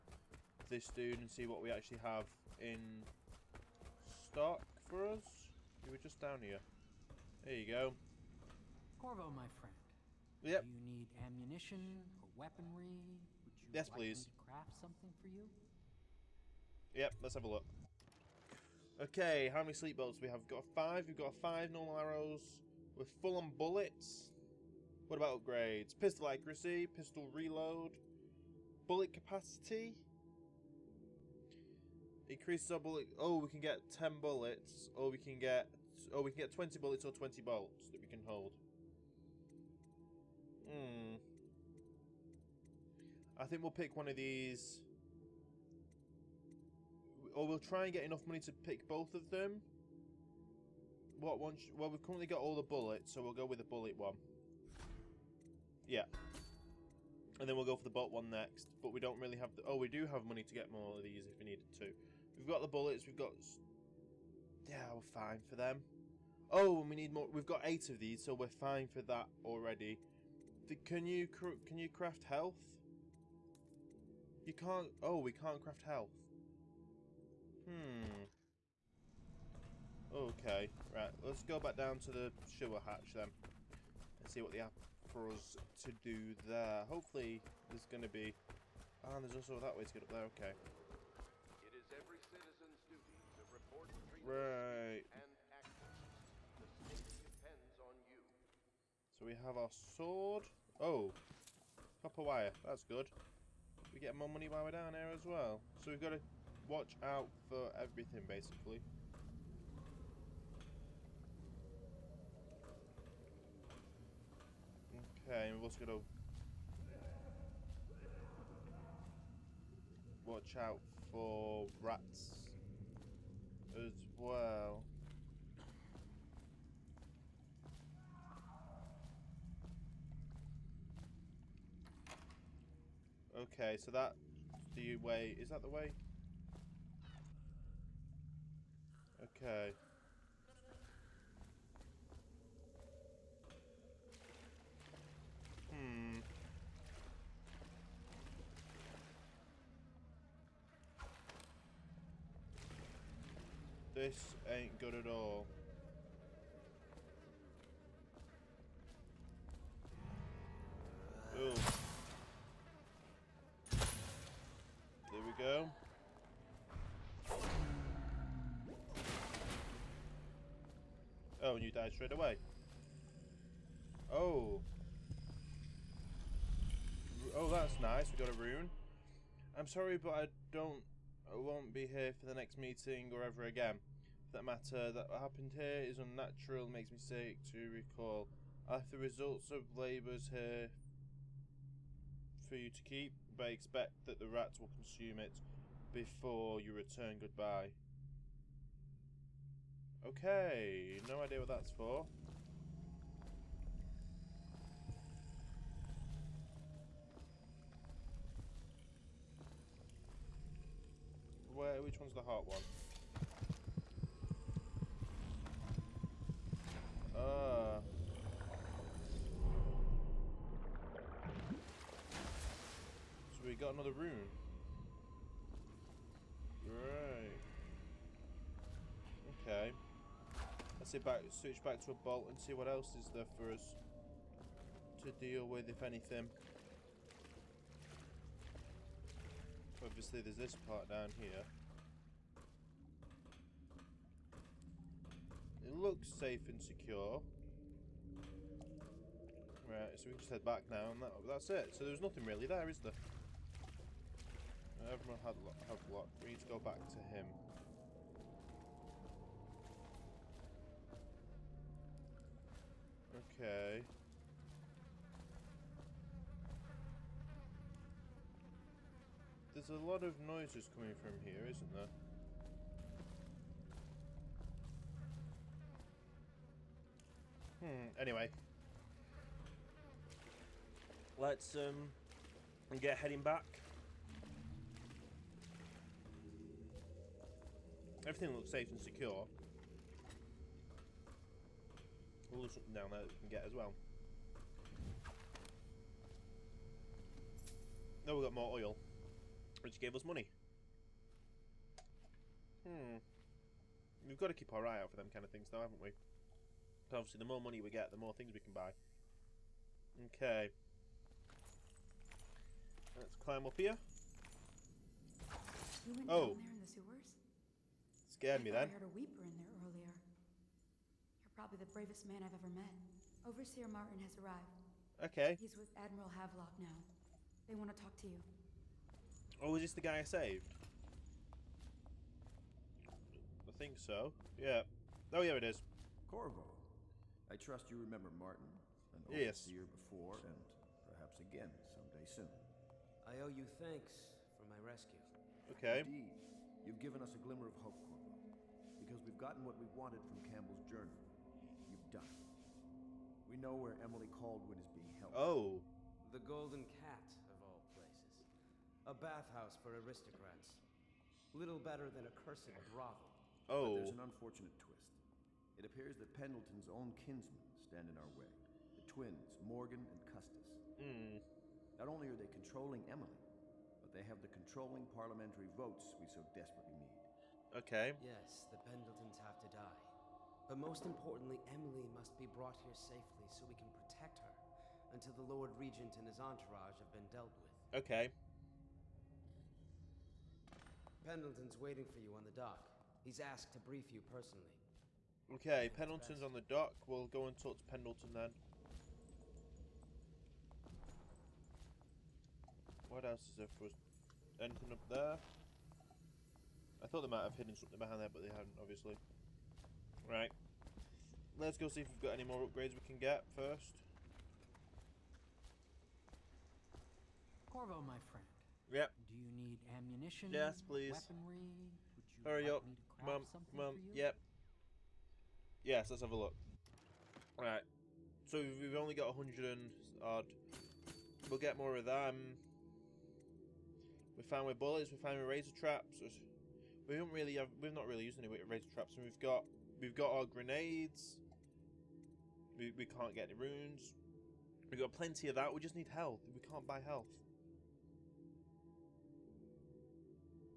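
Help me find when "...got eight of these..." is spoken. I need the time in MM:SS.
01:07.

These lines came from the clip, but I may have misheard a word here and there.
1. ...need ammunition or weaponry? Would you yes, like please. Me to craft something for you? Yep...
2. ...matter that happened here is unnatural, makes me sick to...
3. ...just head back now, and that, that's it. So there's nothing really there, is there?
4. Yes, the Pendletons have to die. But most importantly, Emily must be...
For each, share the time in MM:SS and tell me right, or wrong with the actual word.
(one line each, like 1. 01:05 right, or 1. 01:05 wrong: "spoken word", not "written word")
1. 00:10 right
2. 03:04 right
3. 04:10 right
4. 06:18 right.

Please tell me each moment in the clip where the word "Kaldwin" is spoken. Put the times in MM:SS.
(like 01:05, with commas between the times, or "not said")
05:54.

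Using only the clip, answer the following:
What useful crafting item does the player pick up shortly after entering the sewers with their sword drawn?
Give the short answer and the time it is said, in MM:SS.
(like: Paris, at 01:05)
Copper wire, at 01:42.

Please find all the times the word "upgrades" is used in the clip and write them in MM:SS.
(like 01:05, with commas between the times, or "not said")
00:25, 06:52.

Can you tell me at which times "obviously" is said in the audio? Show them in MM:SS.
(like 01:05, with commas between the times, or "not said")
03:59, 05:06, 06:48.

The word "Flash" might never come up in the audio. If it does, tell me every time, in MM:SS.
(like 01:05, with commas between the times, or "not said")
not said.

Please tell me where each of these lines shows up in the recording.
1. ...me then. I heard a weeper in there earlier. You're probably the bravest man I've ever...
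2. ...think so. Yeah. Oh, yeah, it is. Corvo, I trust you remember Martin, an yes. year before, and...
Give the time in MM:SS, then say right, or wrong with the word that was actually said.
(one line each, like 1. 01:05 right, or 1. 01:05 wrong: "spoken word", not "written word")
1. 05:18 right
2. 05:33 right.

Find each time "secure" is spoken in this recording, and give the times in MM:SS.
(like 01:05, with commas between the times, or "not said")
04:06, 04:48.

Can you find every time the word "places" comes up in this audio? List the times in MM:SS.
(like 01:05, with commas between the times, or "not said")
05:57.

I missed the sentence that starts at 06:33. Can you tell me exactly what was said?
He's asked to brief you personally.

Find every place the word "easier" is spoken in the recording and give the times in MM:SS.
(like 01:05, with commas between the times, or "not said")
not said.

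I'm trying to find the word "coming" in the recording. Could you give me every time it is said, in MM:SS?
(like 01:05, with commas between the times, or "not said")
04:30.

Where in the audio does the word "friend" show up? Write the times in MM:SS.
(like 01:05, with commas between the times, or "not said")
00:09, 06:57.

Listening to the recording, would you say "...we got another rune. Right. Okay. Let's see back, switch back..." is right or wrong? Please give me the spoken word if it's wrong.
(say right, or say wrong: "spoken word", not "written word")
right.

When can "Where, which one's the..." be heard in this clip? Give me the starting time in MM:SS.
03:31.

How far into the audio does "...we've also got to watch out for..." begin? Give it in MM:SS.
01:55.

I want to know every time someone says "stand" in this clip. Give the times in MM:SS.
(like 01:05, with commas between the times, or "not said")
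06:07.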